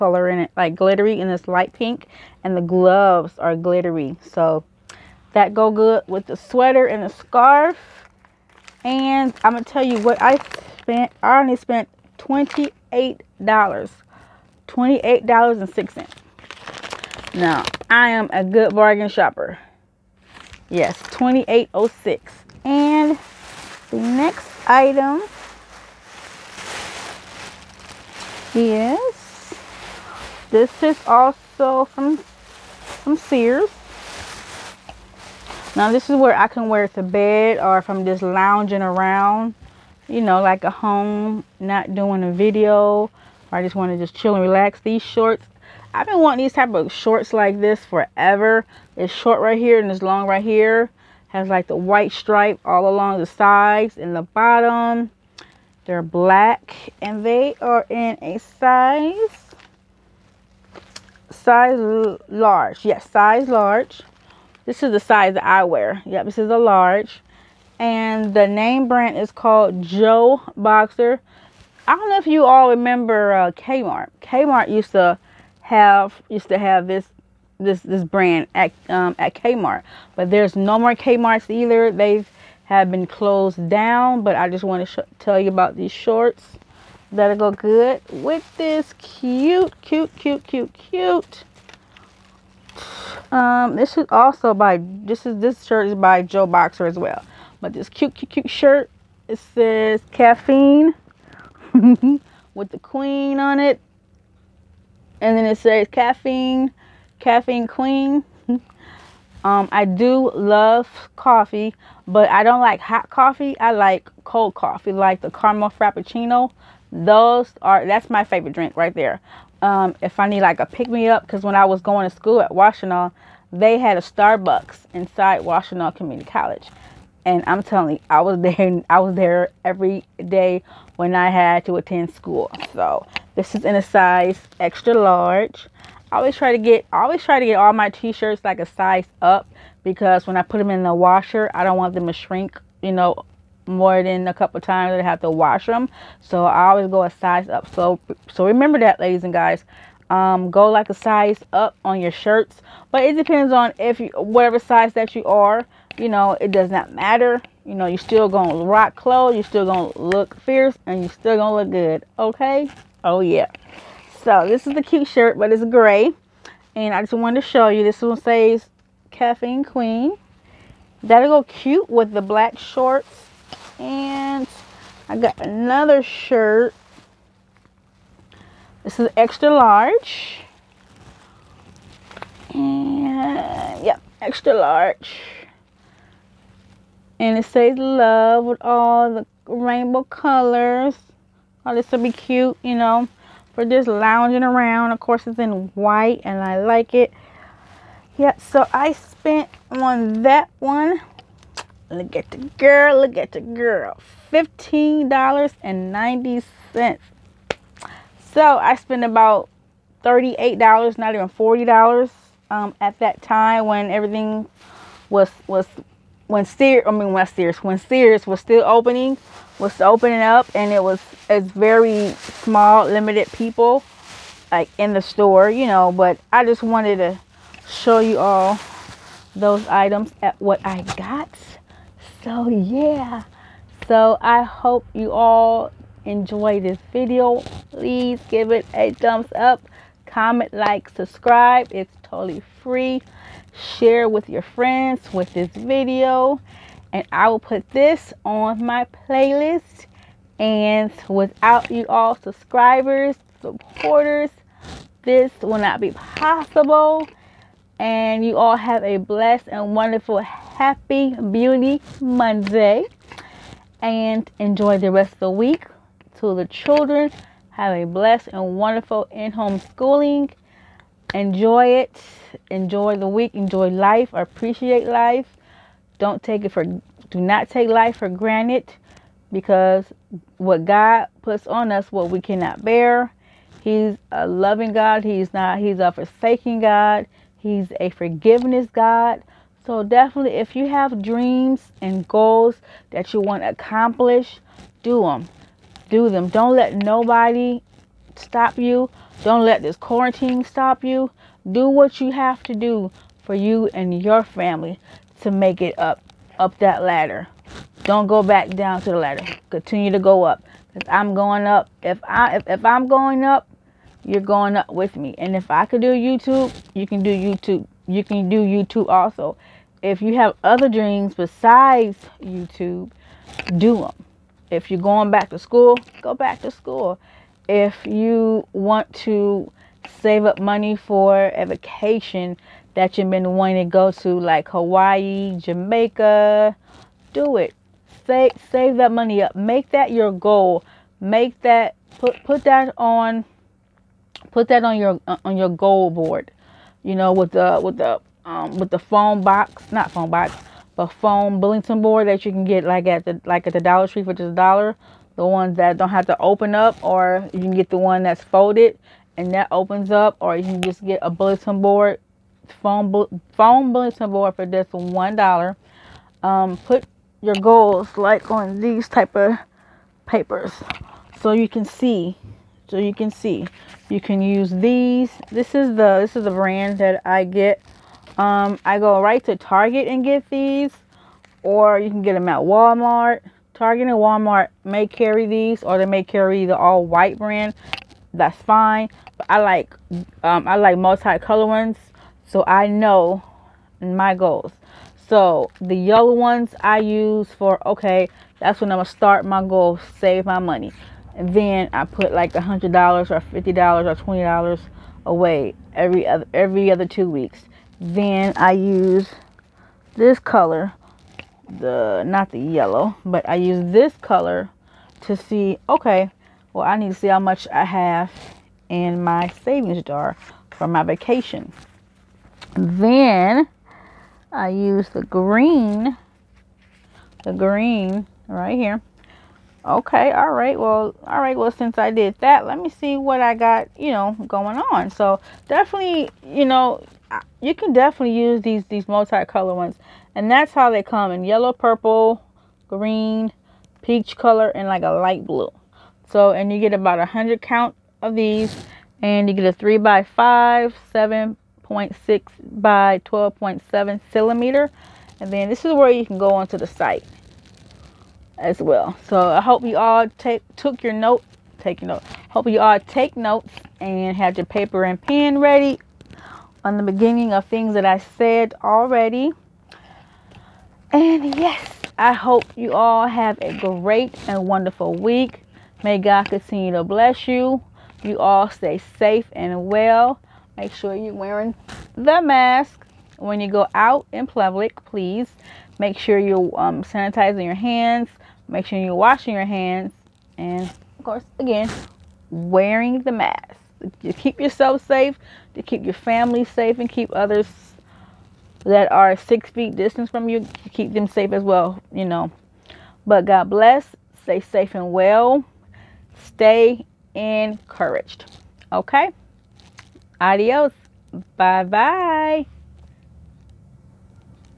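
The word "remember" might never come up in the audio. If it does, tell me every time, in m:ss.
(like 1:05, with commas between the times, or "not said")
1:12, 2:28.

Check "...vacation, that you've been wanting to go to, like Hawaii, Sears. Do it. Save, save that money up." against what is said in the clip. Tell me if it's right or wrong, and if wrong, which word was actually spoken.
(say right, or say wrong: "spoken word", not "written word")
wrong: "Jamaica", not "Sears".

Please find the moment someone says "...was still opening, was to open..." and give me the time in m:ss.
3:38.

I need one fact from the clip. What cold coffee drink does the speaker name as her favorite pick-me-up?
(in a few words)
caramel frappuccino.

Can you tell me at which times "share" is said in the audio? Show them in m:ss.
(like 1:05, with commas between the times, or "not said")
4:03.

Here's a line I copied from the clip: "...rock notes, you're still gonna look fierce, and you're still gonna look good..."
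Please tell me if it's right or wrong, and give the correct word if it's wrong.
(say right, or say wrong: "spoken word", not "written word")
wrong: "clothes", not "notes".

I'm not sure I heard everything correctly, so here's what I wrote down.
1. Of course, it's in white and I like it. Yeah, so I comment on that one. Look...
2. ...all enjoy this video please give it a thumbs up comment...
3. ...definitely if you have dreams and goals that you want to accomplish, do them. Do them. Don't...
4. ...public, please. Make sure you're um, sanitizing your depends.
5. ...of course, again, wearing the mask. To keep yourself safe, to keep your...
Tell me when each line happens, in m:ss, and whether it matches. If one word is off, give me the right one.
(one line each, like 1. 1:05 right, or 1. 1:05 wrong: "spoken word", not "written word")
1. 3:14 wrong: "spent", not "comment"
2. 3:55 right
3. 4:49 right
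4. 8:04 wrong: "hands", not "depends"
5. 8:10 right.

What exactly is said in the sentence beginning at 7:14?
So definitely, you know, you can definitely use these, these multicolor ones.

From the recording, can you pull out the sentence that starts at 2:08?
I was there every day when I had to attend school.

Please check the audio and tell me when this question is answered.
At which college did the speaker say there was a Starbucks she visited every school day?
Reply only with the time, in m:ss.
2:05.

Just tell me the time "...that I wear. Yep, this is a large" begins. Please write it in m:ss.
1:05.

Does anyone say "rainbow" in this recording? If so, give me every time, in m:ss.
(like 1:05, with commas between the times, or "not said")
3:09.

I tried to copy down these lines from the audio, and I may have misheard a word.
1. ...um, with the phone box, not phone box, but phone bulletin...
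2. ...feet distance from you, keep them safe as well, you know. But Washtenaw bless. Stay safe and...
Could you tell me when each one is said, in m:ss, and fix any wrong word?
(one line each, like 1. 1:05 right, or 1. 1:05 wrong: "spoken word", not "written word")
1. 5:48 right
2. 8:19 wrong: "God", not "Washtenaw".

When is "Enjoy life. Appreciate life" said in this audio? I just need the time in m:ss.
4:33.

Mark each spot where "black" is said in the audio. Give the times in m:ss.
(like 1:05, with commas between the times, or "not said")
0:56, 2:52.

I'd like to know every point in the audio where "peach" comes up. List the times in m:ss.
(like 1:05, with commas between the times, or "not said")
7:23.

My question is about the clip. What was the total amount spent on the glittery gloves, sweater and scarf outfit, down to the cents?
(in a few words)
$28.06.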